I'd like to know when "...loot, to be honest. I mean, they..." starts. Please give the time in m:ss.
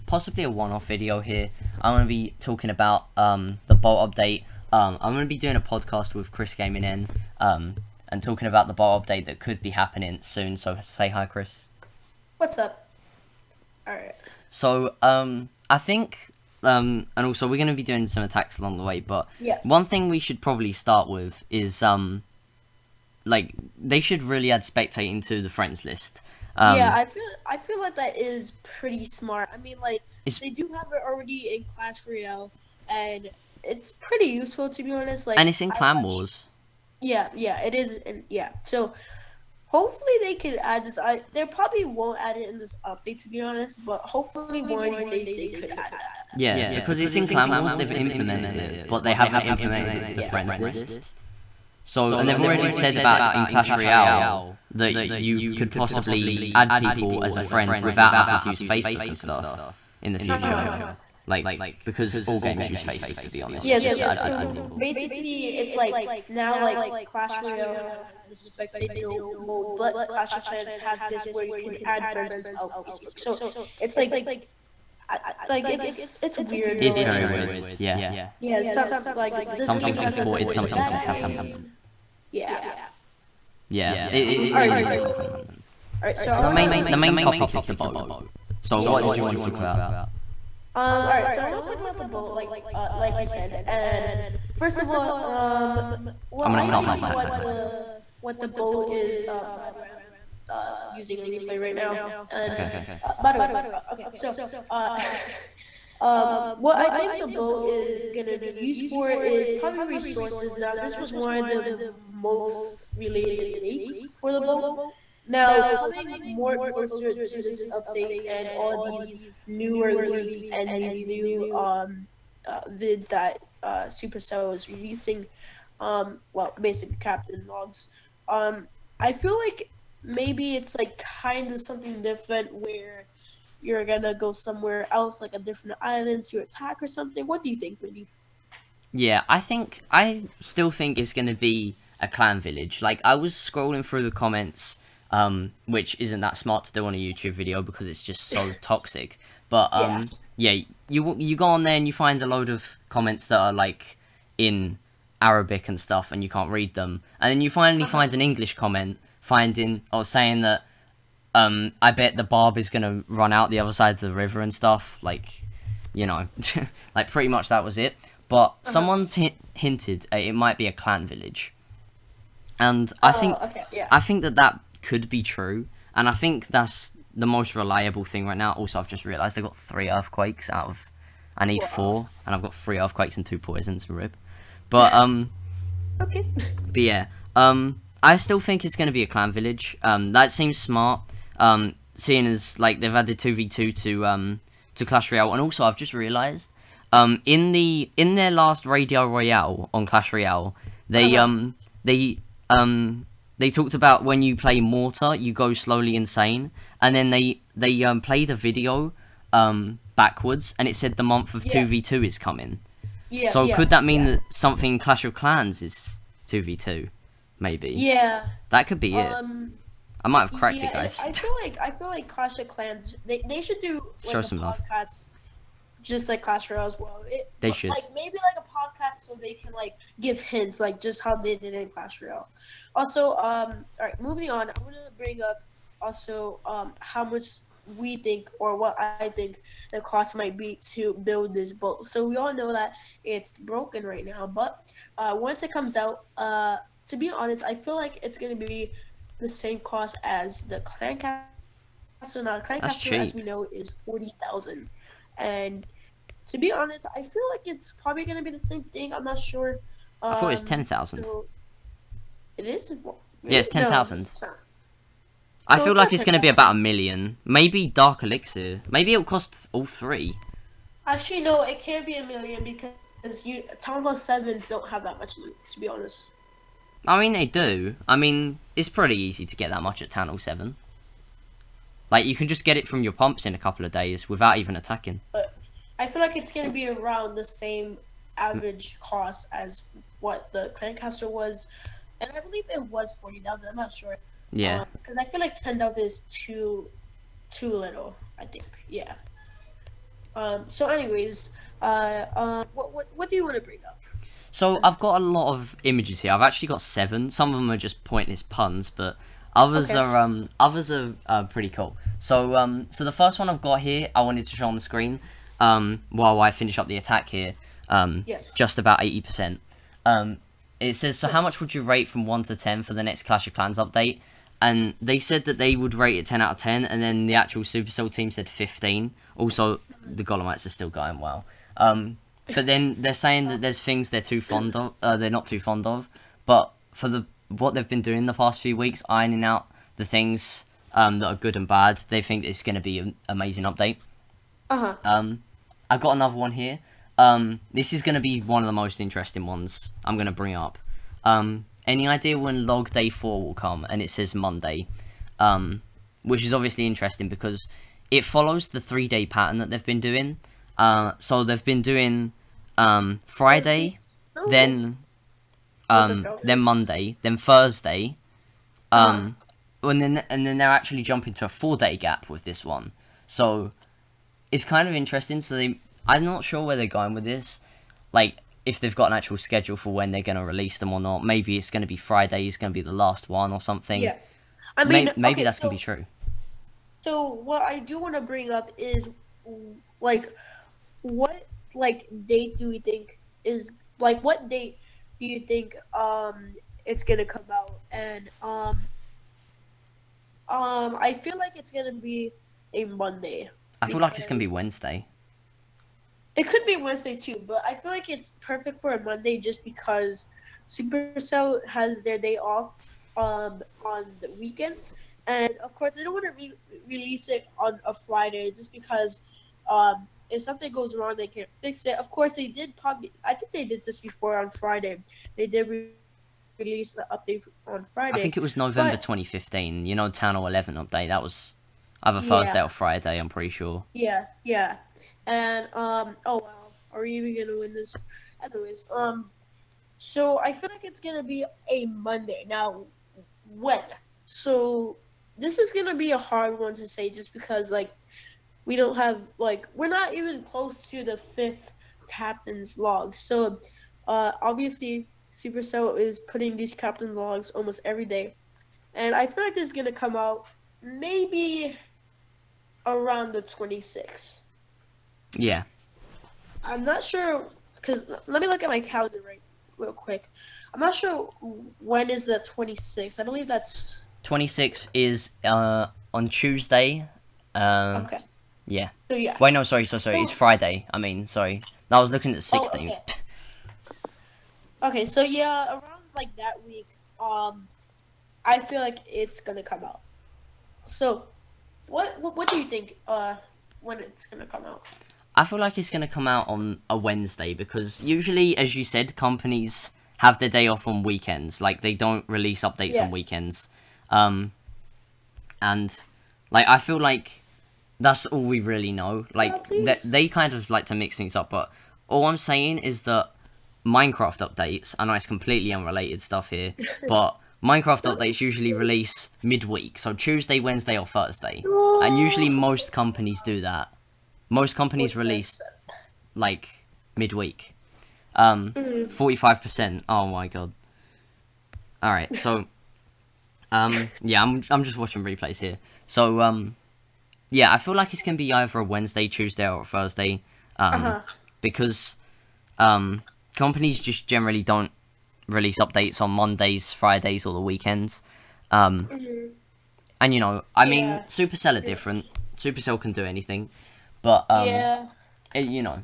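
4:35.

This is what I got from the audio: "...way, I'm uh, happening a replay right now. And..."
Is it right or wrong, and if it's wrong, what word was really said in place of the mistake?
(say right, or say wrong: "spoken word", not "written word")
wrong: "using", not "happening".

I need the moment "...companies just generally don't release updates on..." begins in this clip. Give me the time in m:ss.
9:03.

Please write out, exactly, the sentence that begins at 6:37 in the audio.
And um, um, I feel like it's gonna be a Monday.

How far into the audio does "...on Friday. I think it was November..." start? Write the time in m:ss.
7:07.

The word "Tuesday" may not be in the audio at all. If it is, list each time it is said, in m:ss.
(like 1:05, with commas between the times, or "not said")
7:56, 8:39, 8:59.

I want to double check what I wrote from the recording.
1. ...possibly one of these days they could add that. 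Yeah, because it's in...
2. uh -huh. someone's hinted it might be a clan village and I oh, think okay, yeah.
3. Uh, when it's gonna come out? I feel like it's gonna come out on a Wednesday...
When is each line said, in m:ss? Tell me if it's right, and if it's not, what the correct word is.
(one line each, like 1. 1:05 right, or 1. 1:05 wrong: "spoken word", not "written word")
1. 0:44 wrong: "hopefully", not "possibly"
2. 2:48 right
3. 8:12 right.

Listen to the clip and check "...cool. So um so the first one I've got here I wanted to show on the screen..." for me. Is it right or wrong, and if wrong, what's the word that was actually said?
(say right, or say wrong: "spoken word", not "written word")
right.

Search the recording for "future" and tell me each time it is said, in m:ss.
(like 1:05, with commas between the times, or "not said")
1:00.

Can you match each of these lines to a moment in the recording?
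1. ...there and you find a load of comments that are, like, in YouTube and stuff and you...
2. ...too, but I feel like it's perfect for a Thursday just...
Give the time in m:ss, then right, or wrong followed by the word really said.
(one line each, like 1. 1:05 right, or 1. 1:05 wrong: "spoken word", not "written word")
1. 2:31 wrong: "Arabic", not "YouTube"
2. 6:46 wrong: "Monday", not "Thursday".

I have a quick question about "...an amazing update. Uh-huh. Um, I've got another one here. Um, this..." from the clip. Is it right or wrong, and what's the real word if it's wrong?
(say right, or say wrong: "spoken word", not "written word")
right.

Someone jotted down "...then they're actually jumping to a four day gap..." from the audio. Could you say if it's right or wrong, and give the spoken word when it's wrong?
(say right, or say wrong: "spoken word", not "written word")
right.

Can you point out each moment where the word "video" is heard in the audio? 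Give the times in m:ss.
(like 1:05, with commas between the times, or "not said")
0:00, 2:27, 3:28.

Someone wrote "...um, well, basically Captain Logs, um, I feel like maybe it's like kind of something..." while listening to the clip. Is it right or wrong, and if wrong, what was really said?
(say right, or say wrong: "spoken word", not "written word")
right.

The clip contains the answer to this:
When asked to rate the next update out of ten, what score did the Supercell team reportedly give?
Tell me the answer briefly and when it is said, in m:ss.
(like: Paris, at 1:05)
15, at 5:28.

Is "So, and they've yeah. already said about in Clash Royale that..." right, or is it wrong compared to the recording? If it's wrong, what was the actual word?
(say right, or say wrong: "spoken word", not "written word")
right.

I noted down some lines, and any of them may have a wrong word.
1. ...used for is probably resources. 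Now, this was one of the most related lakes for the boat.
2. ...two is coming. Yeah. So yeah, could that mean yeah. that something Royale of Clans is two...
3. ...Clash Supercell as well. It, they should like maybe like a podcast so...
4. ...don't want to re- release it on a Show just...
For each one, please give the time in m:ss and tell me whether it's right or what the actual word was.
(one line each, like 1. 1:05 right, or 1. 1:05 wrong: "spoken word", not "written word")
1. 1:48 right
2. 3:31 wrong: "Clash", not "Royale"
3. 3:46 wrong: "Royale", not "Supercell"
4. 6:55 wrong: "Friday", not "Show".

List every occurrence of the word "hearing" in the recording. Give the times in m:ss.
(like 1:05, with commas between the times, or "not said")
not said.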